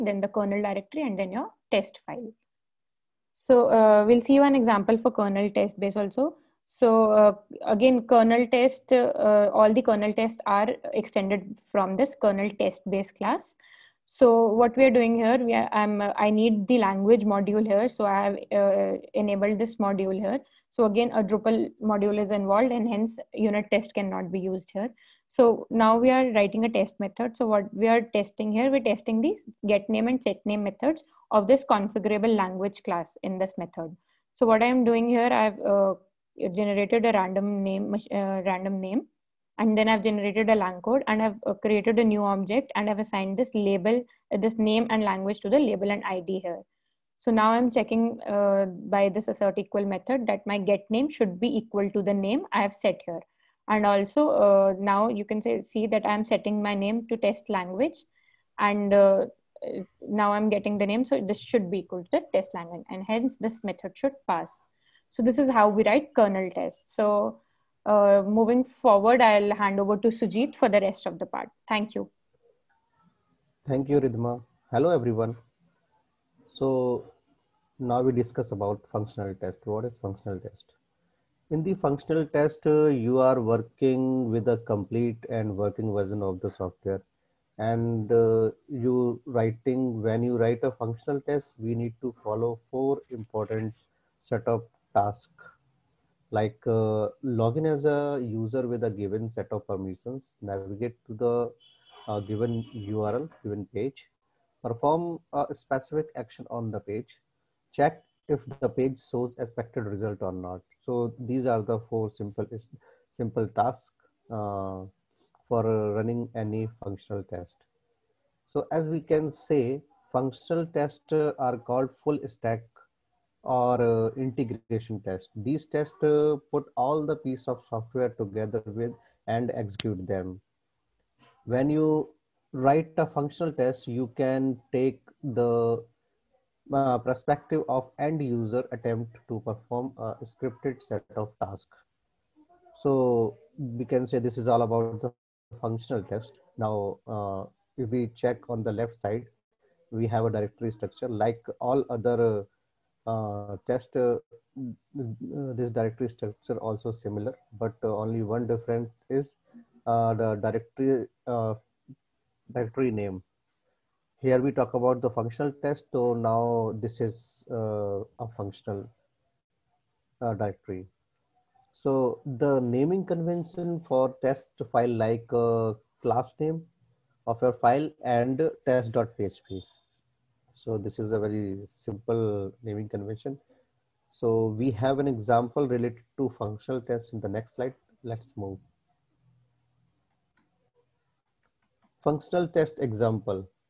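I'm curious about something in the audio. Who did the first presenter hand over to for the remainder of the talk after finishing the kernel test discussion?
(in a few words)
Sujeet.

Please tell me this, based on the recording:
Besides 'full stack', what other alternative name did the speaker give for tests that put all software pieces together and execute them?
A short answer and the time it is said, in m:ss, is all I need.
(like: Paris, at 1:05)
integration test, at 2:04.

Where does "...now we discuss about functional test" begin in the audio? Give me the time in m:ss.
1:17.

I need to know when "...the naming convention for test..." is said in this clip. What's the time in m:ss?
2:52.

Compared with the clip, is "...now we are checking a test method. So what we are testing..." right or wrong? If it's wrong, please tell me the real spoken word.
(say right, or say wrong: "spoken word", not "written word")
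wrong: "writing", not "checking".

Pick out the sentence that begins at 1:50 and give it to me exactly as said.
So these are the four simple, simple tasks uh, for running any functional test.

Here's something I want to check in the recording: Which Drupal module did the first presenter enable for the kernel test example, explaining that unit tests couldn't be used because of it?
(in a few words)
language module.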